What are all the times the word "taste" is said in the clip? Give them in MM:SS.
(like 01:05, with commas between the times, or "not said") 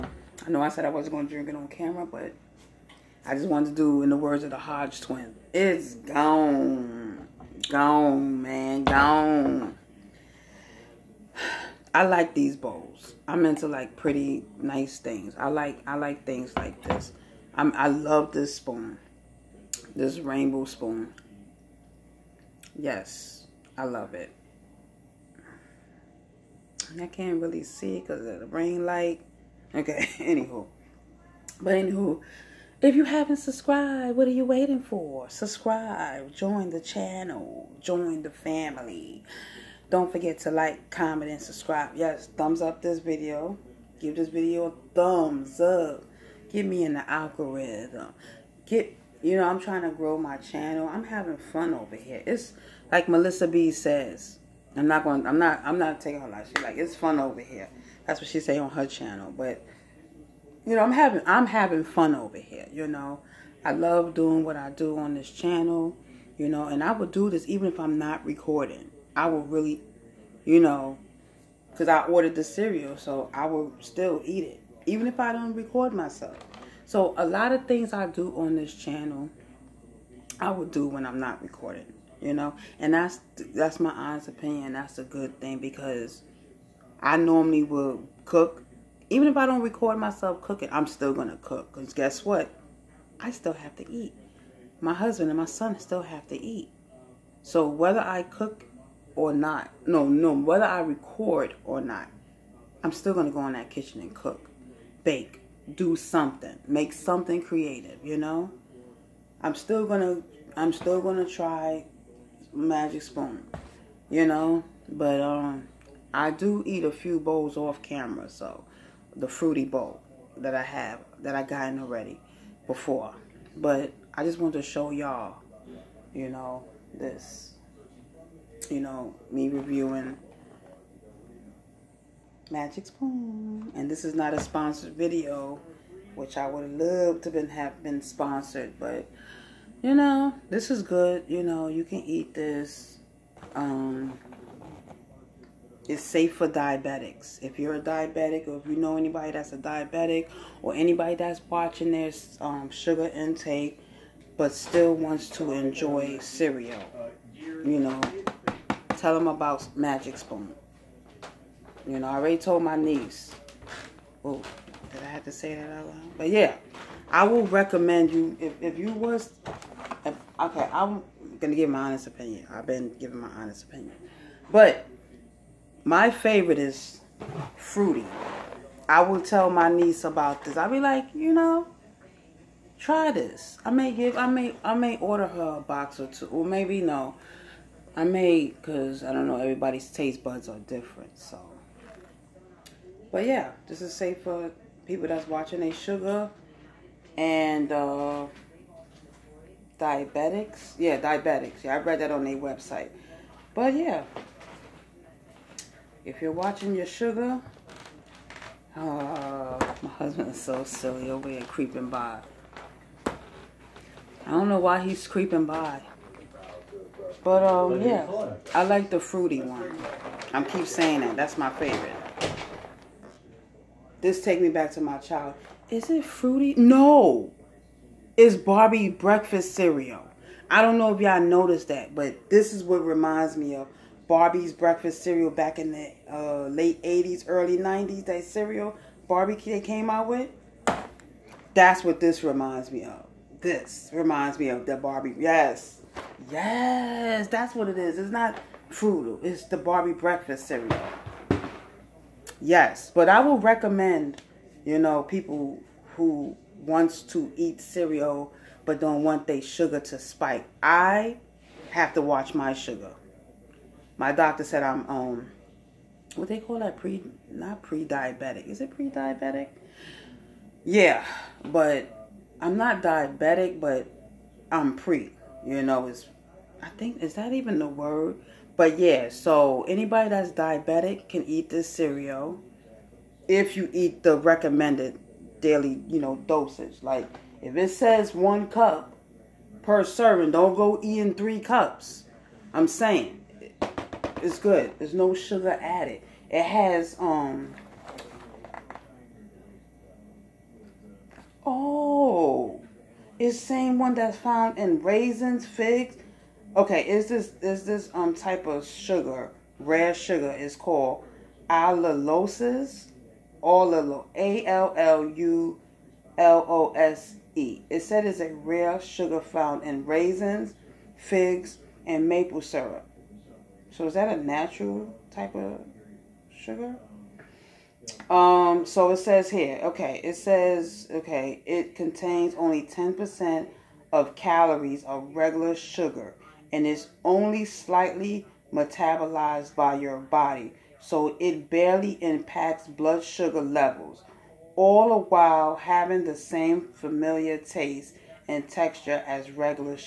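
03:09, 05:47.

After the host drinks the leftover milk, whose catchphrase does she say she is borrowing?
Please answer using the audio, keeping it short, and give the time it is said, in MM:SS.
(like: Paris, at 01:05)
Hodge twins, at 00:04.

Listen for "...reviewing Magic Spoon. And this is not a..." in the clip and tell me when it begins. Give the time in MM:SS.
02:09.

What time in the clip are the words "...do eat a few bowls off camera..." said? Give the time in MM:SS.
01:56.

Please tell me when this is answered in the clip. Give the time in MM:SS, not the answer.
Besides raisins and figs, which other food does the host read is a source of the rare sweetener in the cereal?
05:22.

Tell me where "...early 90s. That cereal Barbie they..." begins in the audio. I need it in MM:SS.
03:57.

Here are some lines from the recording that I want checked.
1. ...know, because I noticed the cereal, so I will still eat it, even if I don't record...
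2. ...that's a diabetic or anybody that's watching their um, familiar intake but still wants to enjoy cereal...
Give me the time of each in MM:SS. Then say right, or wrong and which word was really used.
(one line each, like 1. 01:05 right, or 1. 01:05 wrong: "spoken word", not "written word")
1. 01:10 wrong: "ordered", not "noticed"
2. 02:29 wrong: "sugar", not "familiar".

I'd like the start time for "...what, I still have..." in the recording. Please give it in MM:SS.
01:32.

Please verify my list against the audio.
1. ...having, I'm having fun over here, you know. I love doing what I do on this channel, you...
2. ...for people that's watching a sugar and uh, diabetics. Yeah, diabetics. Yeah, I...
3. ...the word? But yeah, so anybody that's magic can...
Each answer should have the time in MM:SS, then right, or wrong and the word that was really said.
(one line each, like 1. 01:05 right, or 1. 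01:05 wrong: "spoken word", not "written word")
1. 01:00 right
2. 03:14 right
3. 04:37 wrong: "diabetic", not "magic".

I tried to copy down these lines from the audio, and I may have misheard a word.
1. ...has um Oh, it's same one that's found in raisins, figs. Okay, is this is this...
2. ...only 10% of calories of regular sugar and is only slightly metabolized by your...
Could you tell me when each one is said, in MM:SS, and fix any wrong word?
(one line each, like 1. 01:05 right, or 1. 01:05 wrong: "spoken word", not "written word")
1. 04:56 right
2. 05:32 right.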